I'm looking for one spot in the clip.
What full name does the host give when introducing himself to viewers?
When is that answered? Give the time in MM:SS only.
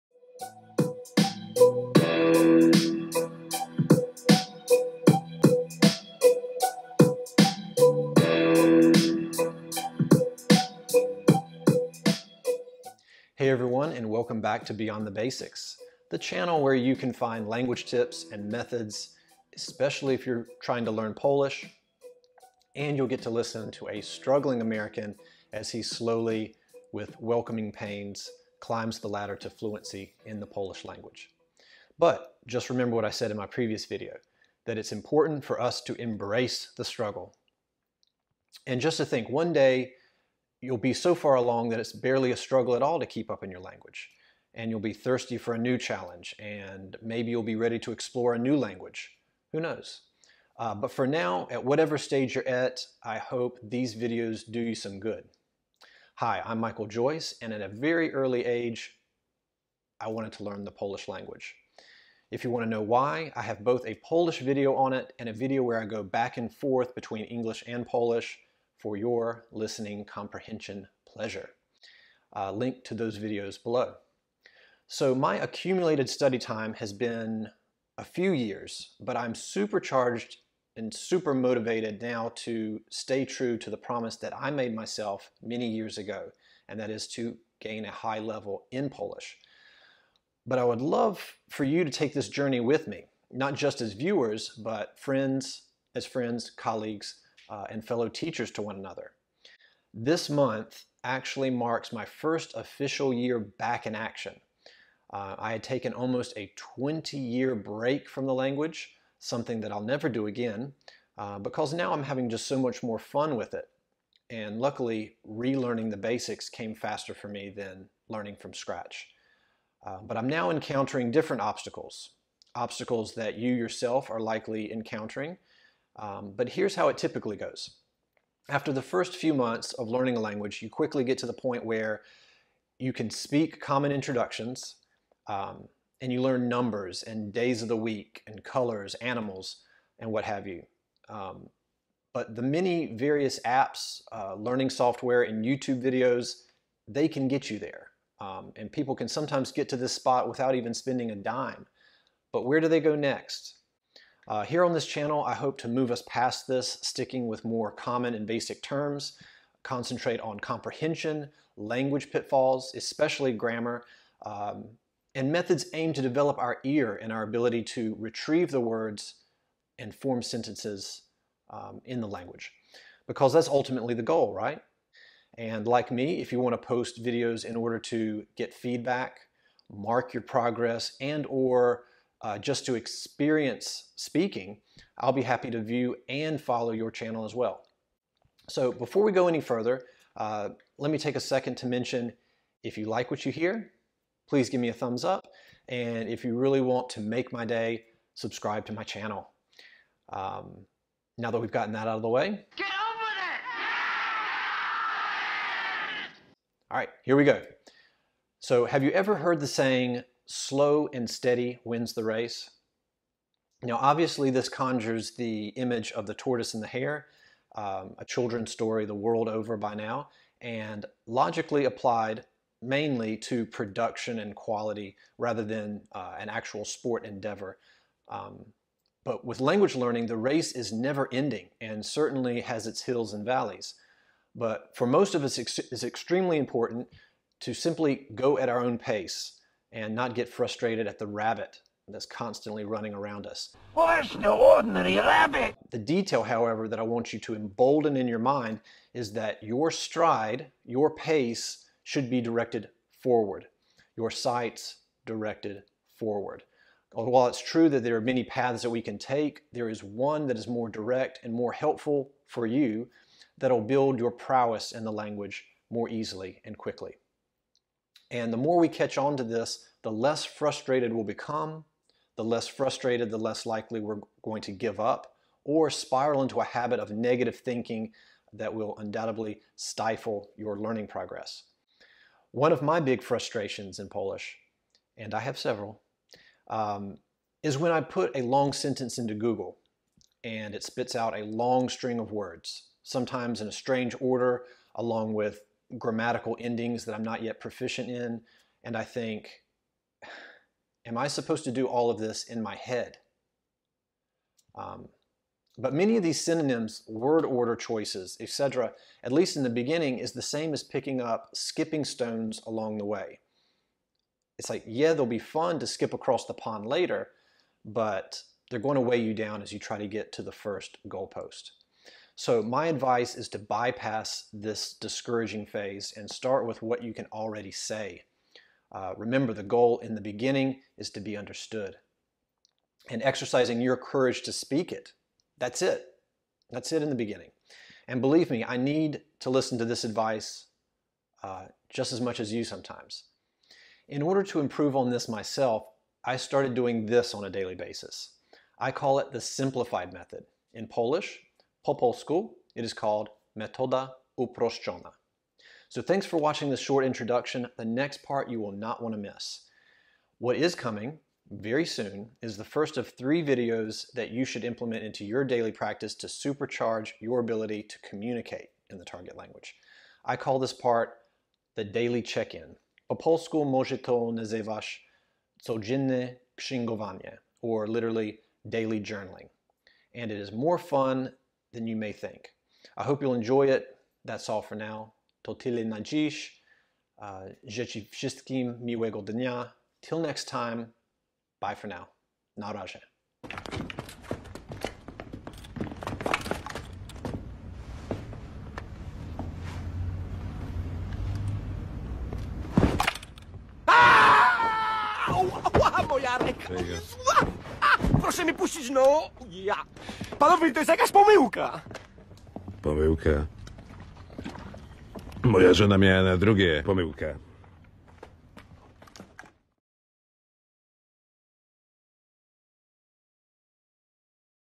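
00:56.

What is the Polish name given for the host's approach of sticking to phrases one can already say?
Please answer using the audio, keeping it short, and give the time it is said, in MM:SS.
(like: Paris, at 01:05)
metoda uproszczona, at 05:53.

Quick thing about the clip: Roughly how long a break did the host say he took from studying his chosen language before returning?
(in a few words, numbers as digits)
20 years.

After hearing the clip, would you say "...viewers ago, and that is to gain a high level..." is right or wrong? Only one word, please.
wrong.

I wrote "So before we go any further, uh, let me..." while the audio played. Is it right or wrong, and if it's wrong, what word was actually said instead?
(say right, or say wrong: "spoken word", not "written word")
right.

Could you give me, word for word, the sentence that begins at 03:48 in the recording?
Um, but with language learning, the race is never ending and certainly has its hills and valleys.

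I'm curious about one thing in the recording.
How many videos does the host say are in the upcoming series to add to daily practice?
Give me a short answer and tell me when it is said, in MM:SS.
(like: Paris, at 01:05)
3, at 06:02.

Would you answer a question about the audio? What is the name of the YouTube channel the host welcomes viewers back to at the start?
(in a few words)
Beyond the Basics.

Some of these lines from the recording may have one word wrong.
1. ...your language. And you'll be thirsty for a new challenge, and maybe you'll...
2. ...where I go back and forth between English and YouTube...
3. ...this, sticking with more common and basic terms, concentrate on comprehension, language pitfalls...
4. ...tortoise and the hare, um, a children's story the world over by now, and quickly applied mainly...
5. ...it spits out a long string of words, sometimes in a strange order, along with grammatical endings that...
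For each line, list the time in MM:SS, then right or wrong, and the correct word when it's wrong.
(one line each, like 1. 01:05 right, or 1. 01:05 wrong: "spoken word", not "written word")
1. 00:43 right
2. 01:05 wrong: "Polish", not "YouTube"
3. 02:36 right
4. 03:36 wrong: "logically", not "quickly"
5. 04:50 right.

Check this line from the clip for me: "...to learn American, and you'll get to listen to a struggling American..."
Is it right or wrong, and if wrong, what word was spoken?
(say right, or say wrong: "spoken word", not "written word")
wrong: "Polish", not "American".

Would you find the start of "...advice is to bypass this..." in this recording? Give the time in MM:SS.
05:22.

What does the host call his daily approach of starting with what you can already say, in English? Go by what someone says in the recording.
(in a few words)
the simplified method.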